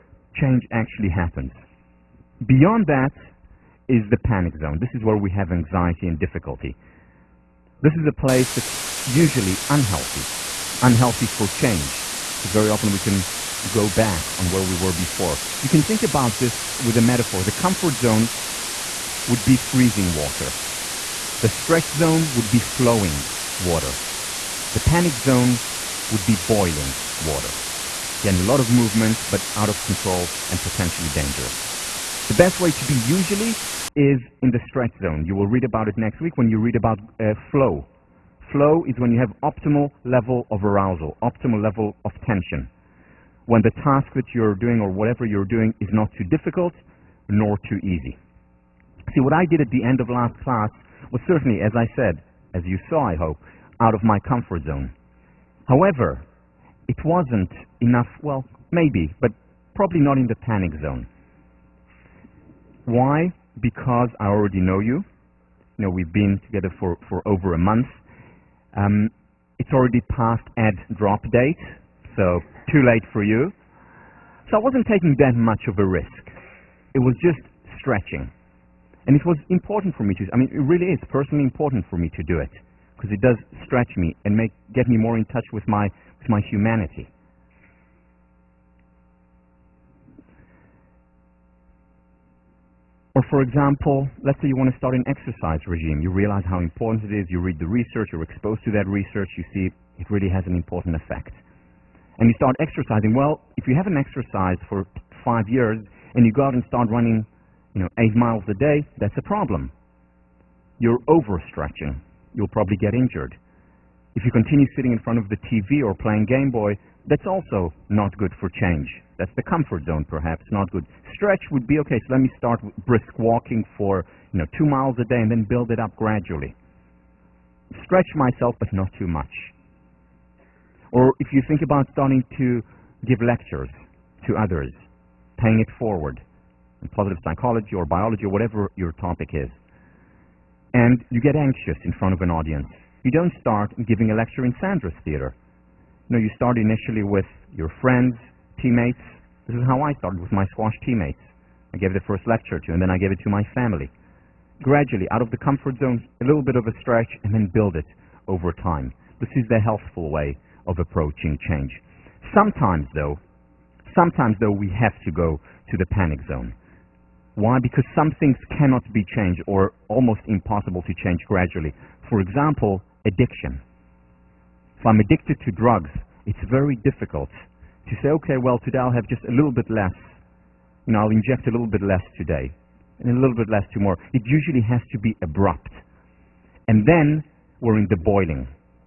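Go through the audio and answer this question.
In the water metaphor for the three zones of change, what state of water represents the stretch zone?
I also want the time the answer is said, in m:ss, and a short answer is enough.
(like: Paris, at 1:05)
Flowing water, at 0:22.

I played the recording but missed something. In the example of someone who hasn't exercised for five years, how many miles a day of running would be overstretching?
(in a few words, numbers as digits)
8.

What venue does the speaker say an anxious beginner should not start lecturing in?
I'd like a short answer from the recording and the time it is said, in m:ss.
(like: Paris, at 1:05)
Sanders Theater, at 2:24.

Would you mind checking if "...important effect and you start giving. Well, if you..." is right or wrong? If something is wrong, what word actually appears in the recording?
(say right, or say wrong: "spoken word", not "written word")
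wrong: "exercising", not "giving".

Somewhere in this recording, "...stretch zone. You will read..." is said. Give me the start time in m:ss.
0:34.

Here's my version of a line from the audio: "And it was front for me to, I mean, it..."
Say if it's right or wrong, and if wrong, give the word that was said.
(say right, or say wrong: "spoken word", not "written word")
wrong: "important", not "front".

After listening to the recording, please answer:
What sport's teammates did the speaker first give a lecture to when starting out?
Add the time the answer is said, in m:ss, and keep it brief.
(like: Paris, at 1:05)
Squash, at 2:30.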